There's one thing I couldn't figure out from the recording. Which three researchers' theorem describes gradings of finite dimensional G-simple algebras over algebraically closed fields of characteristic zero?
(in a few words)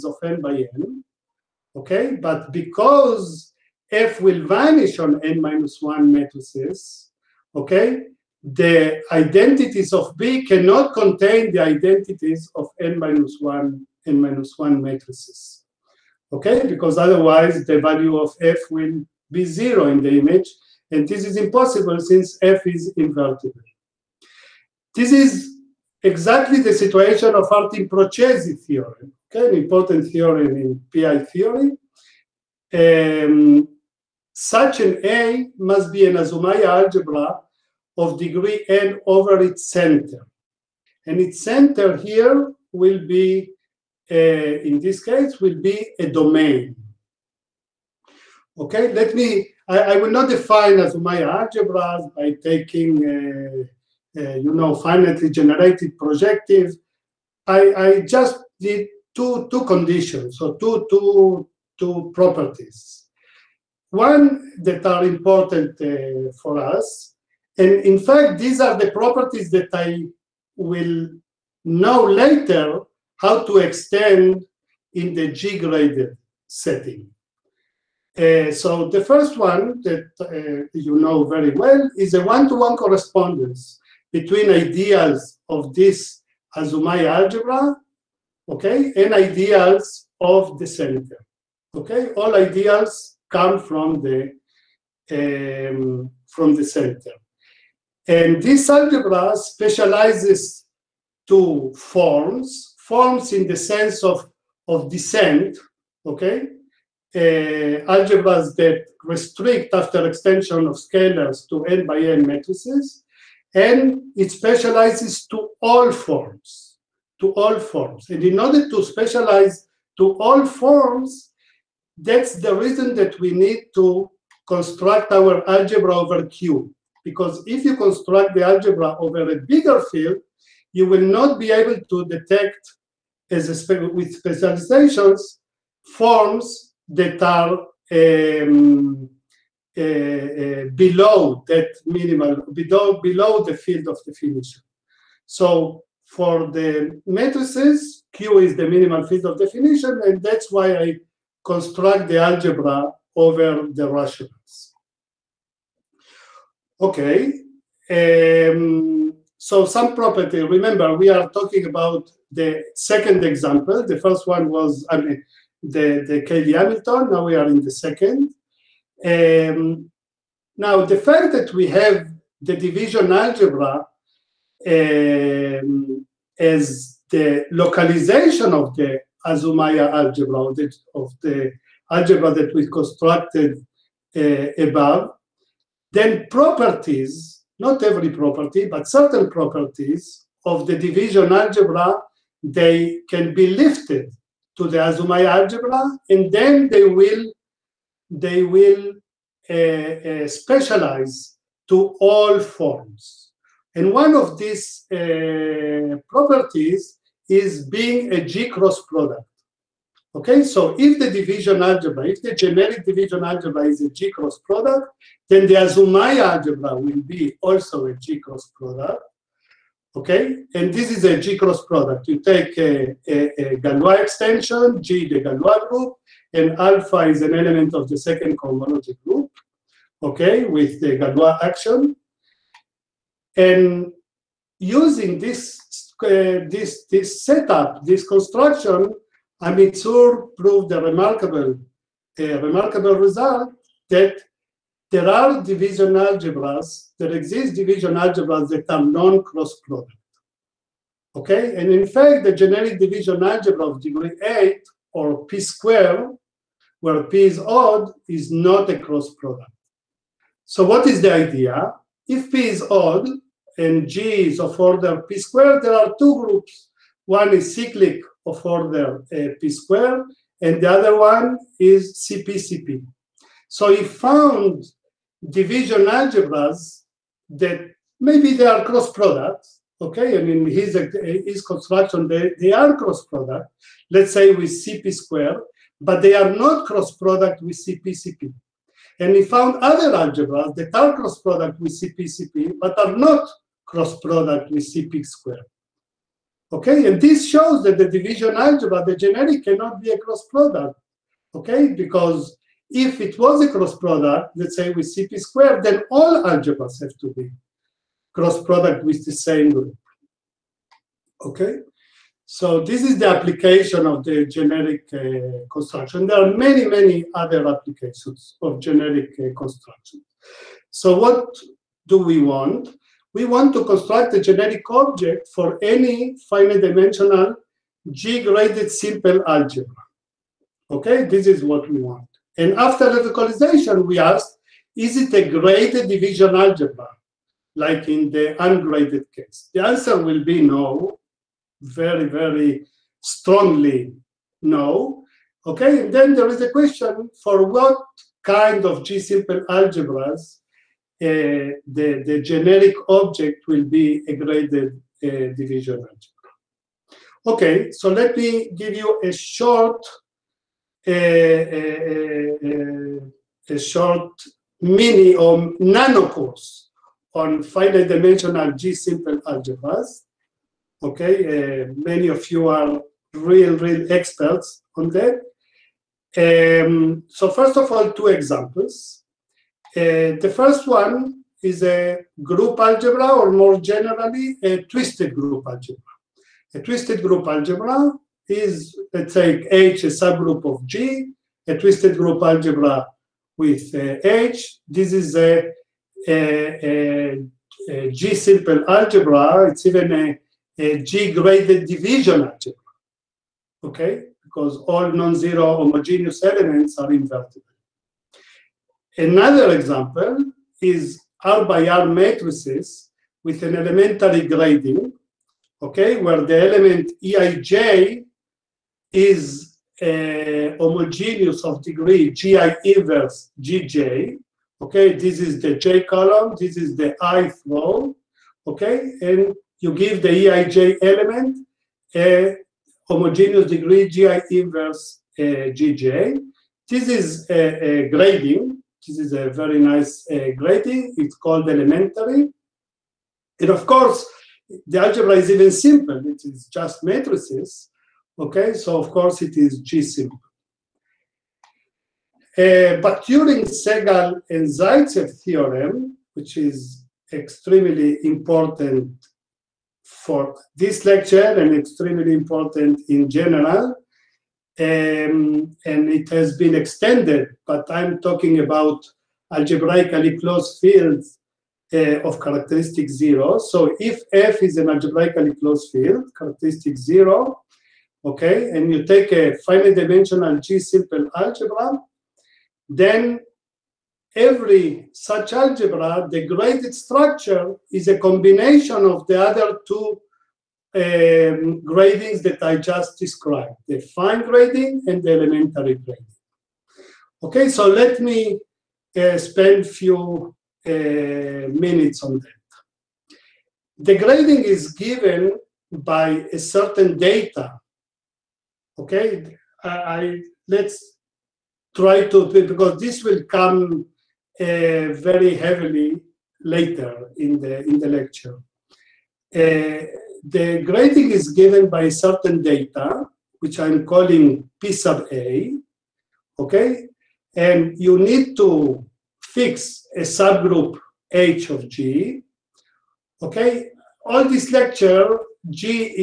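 Bakhturin, Sehgal, and Zaitsev.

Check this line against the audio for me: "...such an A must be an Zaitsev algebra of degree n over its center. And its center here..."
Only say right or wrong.
wrong.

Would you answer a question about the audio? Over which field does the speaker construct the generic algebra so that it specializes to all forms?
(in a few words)
the rationals.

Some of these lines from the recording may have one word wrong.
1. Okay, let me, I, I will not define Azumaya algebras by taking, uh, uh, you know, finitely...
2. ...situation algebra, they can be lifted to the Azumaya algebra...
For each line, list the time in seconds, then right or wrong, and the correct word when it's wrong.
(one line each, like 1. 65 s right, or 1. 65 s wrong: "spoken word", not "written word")
1. 48 s right
2. 190 s wrong: "division", not "situation".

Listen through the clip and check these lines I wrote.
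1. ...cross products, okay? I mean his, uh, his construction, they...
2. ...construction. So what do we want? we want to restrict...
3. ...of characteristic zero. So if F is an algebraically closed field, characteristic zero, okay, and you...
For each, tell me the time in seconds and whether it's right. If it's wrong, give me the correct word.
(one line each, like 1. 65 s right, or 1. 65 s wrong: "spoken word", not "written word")
1. 278 s right
2. 319 s wrong: "construct", not "restrict"
3. 472 s right.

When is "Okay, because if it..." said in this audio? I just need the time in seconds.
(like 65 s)
301 s.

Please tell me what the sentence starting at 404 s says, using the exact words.
Because all non-zero homogeneous elements are invertible.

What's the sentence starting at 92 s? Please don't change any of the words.
All ideals come from the um, from the center.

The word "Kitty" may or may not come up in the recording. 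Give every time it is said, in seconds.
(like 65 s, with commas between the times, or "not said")
not said.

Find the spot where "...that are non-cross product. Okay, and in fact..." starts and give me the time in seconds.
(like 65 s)
248 s.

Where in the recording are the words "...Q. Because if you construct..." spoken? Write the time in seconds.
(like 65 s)
126 s.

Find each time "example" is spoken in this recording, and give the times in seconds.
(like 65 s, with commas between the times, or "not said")
163 s, 378 s, 409 s.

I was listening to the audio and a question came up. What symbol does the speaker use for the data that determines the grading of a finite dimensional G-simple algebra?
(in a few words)
P sub A.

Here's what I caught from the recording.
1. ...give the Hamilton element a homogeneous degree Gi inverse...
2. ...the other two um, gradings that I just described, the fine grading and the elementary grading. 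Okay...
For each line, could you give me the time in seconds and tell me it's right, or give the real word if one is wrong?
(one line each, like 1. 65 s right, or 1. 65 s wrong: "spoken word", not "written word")
1. 429 s wrong: "Eij", not "Hamilton"
2. 489 s right.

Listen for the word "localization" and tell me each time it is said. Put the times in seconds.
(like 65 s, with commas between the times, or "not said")
177 s, 332 s.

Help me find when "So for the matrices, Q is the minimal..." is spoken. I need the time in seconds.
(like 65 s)
145 s.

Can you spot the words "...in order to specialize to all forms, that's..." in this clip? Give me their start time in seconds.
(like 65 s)
118 s.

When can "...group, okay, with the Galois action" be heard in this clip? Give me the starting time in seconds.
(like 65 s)
229 s.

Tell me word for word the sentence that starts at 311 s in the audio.
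Okay, so this is the application of the generic uh, construction.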